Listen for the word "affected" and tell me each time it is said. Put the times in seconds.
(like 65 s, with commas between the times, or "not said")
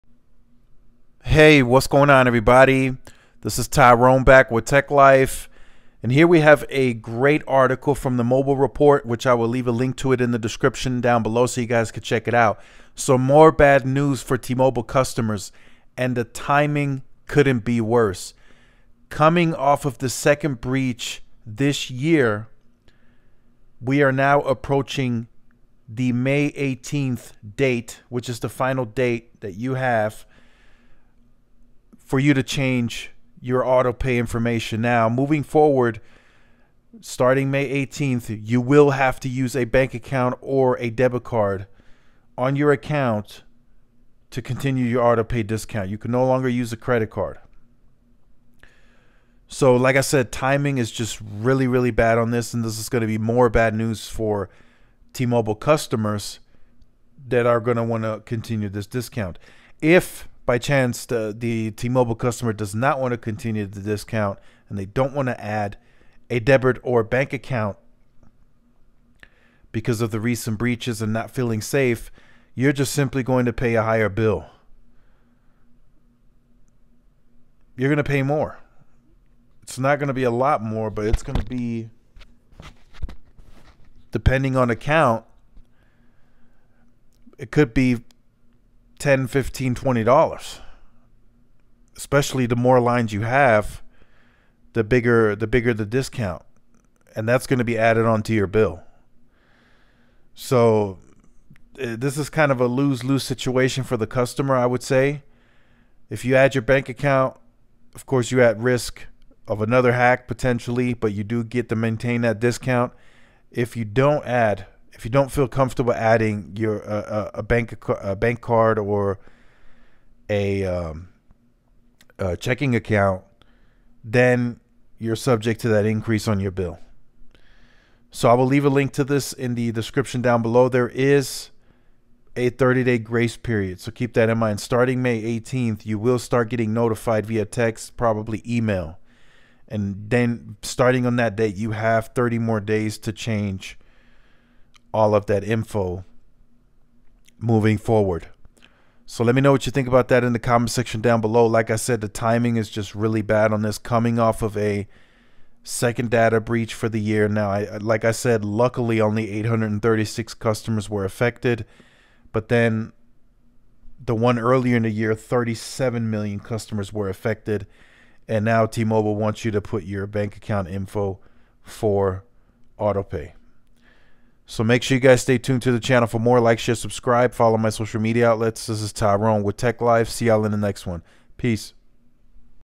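161 s, 167 s.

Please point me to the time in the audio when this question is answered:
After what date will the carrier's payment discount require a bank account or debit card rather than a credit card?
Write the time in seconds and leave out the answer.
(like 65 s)
26 s.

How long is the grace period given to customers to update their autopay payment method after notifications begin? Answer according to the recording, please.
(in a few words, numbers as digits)
30 days.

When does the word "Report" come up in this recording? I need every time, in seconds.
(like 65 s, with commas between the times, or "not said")
8 s.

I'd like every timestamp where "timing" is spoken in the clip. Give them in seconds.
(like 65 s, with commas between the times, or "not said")
16 s, 50 s, 152 s.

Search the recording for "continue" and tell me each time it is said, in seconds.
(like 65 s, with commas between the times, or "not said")
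44 s, 58 s, 63 s.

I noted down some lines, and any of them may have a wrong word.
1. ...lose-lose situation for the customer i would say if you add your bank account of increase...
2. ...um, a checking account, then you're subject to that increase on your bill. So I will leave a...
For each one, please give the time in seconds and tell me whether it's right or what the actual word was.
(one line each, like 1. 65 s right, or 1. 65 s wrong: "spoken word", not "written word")
1. 102 s wrong: "course", not "increase"
2. 120 s right.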